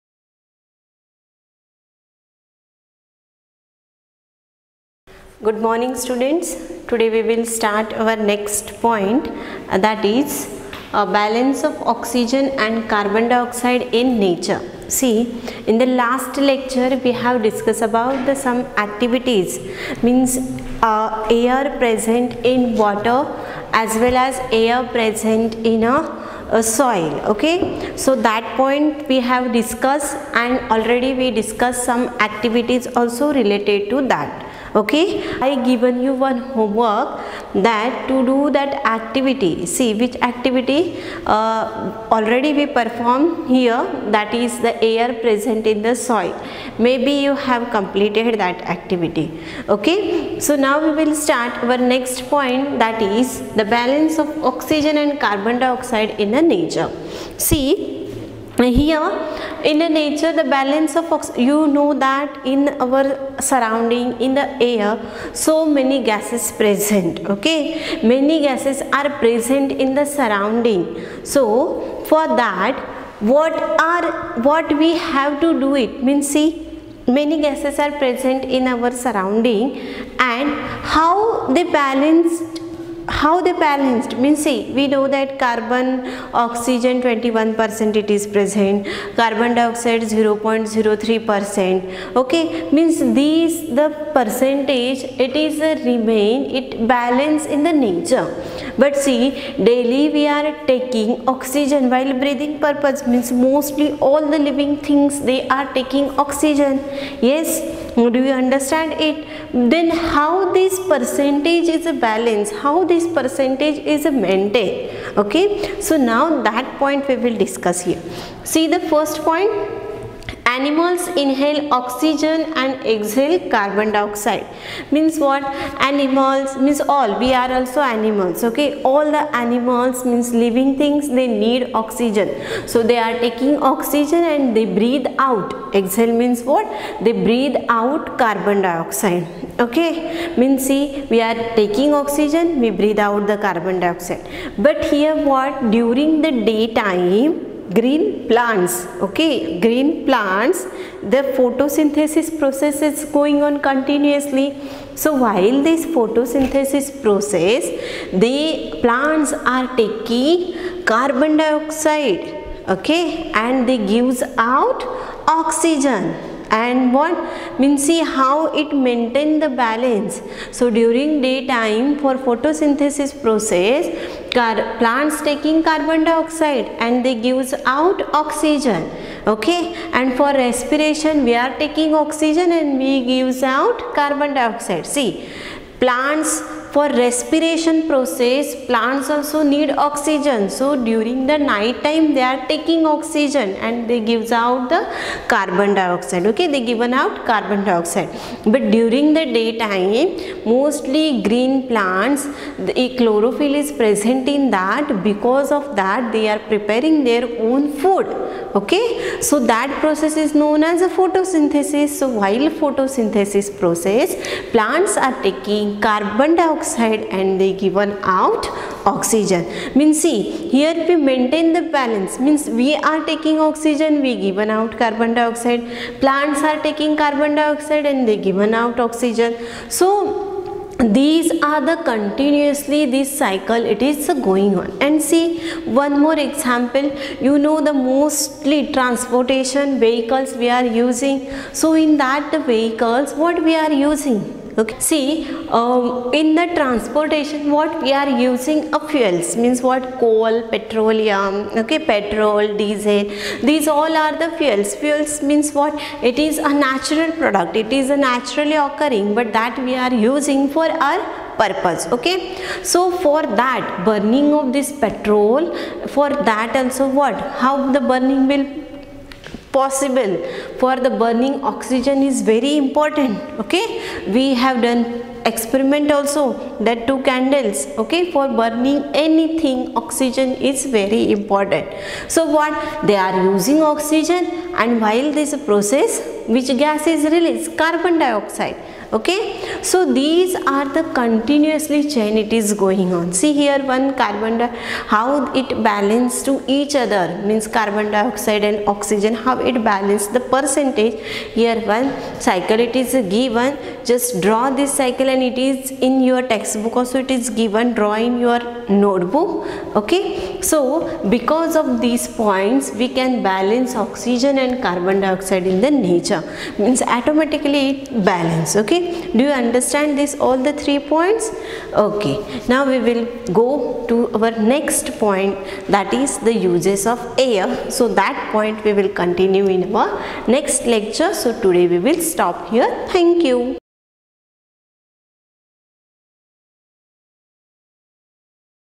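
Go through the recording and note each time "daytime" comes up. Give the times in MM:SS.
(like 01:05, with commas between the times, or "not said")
02:26, 02:51, 03:19.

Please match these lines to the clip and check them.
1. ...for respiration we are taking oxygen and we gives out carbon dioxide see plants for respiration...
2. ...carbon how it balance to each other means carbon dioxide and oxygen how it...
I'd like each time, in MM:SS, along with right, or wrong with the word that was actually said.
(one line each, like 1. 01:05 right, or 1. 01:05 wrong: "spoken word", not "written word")
1. 03:00 right
2. 04:54 right.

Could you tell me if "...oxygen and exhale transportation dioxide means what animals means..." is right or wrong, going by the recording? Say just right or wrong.
wrong.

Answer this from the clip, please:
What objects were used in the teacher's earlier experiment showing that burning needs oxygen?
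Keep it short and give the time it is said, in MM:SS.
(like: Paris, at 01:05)
two candles, at 04:36.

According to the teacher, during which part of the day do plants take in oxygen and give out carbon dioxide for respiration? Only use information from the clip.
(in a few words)
night time.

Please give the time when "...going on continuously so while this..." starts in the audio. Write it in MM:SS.
02:33.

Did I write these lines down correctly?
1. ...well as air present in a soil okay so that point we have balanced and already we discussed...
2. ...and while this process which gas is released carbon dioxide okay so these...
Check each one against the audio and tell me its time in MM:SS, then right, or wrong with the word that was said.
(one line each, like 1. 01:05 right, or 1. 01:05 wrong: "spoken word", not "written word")
1. 00:24 wrong: "discussed", not "balanced"
2. 04:44 right.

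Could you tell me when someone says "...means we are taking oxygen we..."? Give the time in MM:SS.
03:42.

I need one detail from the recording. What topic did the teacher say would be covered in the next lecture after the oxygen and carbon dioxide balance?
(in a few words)
uses of air.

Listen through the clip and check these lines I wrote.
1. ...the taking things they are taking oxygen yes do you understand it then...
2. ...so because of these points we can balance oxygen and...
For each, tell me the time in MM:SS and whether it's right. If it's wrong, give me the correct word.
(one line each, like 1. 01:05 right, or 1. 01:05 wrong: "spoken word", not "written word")
1. 01:44 wrong: "living", not "taking"
2. 05:10 right.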